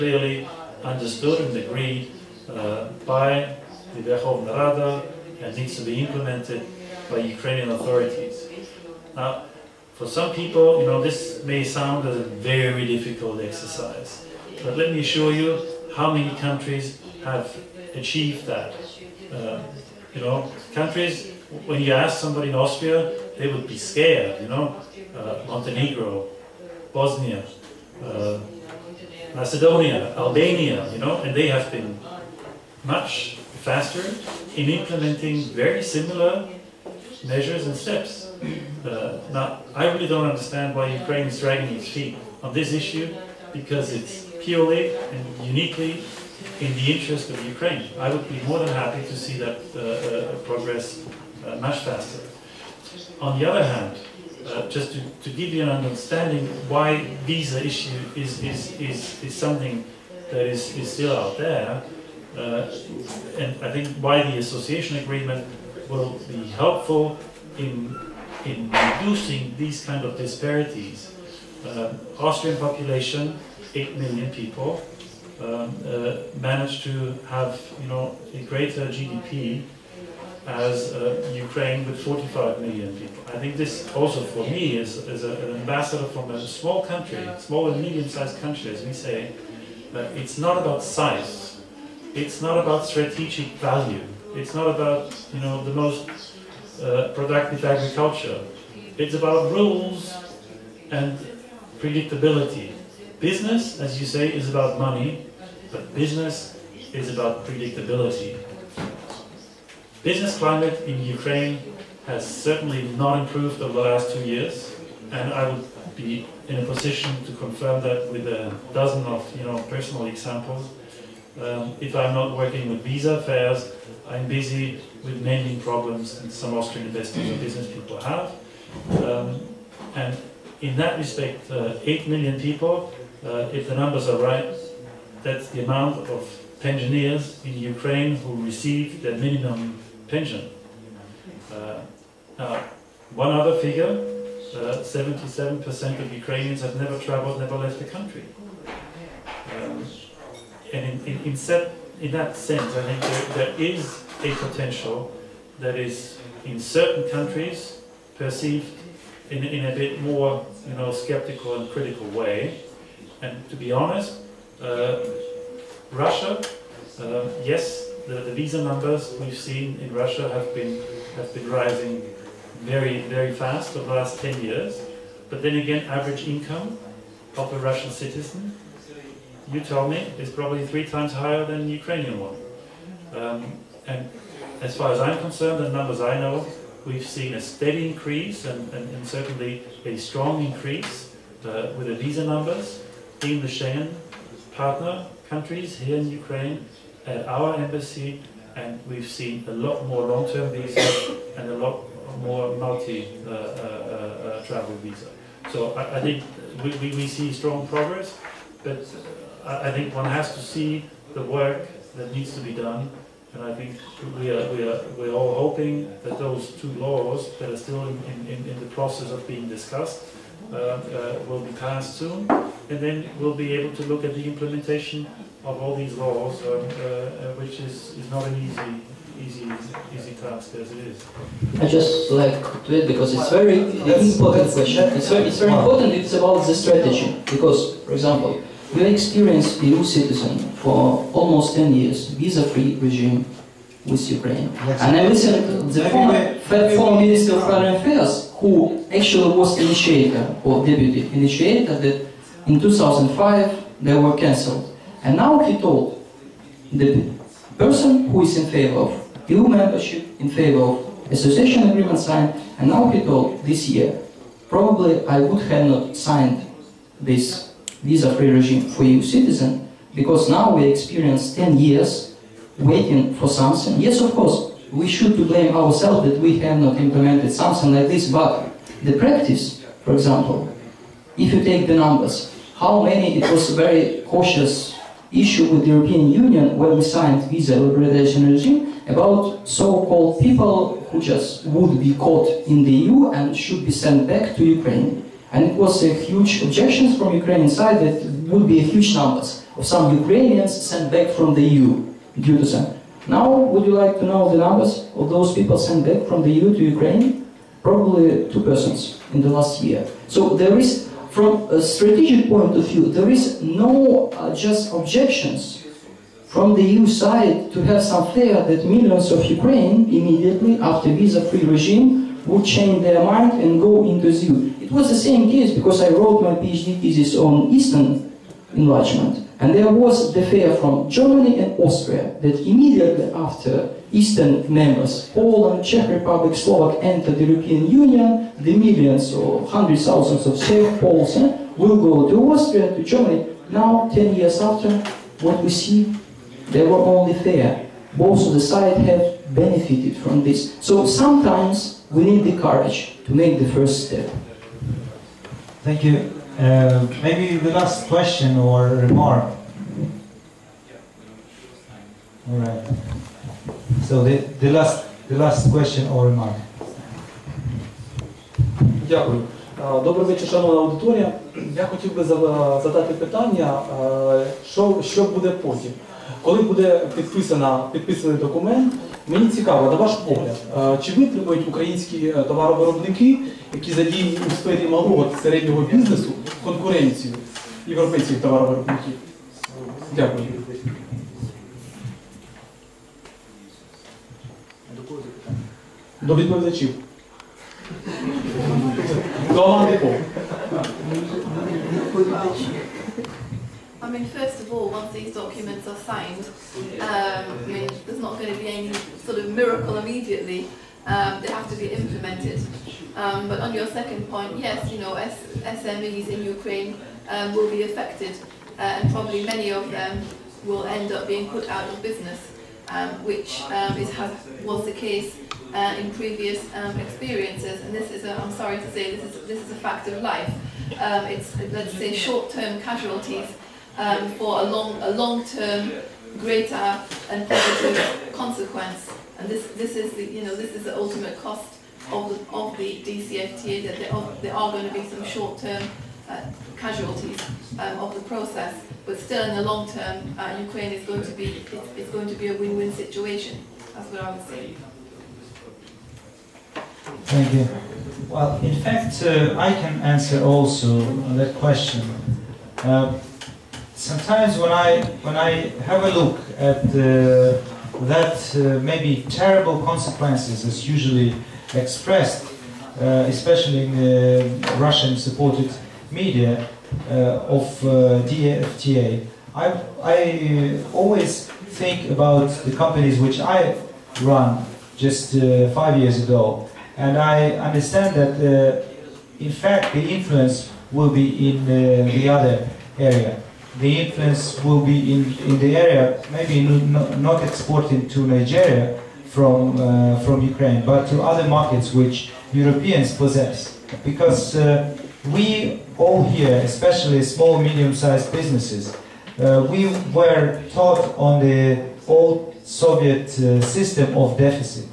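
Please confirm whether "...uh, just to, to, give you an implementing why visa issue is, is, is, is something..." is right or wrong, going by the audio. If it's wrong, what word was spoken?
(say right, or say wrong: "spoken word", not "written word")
wrong: "understanding", not "implementing".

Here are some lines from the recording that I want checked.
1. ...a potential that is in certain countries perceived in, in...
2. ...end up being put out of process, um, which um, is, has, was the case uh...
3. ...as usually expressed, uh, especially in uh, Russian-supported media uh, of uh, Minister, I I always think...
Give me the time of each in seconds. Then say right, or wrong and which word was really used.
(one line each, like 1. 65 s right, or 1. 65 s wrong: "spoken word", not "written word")
1. 154 s right
2. 420 s wrong: "business", not "process"
3. 470 s wrong: "DFTA", not "Minister".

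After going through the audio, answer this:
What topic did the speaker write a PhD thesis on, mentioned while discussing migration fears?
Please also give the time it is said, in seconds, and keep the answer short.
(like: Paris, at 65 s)
Eastern enlargement, at 327 s.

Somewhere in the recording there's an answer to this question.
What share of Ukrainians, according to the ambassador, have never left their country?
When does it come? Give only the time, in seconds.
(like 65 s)
144 s.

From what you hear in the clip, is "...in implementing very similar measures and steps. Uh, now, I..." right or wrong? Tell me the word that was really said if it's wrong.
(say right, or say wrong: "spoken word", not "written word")
right.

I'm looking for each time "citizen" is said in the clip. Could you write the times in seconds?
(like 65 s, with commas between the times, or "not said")
177 s, 239 s, 269 s.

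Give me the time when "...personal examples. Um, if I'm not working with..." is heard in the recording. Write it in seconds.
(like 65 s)
119 s.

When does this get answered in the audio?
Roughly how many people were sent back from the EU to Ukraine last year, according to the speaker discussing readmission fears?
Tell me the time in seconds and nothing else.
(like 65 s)
308 s.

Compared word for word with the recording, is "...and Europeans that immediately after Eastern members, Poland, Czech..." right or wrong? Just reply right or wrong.
wrong.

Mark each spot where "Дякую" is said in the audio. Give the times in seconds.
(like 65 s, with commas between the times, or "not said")
368 s, 389 s.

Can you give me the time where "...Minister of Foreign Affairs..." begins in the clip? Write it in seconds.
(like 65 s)
246 s.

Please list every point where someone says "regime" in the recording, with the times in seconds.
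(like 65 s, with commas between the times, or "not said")
242 s, 268 s, 288 s, 321 s.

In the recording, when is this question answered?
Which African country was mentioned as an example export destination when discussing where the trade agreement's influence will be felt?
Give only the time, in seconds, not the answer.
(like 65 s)
497 s.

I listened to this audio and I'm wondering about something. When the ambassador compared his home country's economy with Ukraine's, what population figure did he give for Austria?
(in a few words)
8 million.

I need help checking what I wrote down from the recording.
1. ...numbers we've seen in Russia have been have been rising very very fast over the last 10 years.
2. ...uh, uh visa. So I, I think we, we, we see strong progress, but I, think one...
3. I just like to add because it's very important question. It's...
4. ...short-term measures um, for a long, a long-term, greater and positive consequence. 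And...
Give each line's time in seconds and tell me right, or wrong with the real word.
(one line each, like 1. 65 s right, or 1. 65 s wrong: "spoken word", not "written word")
1. 168 s right
2. 204 s right
3. 231 s right
4. 431 s wrong: "casualties", not "measures".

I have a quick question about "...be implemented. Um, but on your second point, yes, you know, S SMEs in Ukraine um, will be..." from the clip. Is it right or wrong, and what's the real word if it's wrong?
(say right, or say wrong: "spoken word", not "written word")
right.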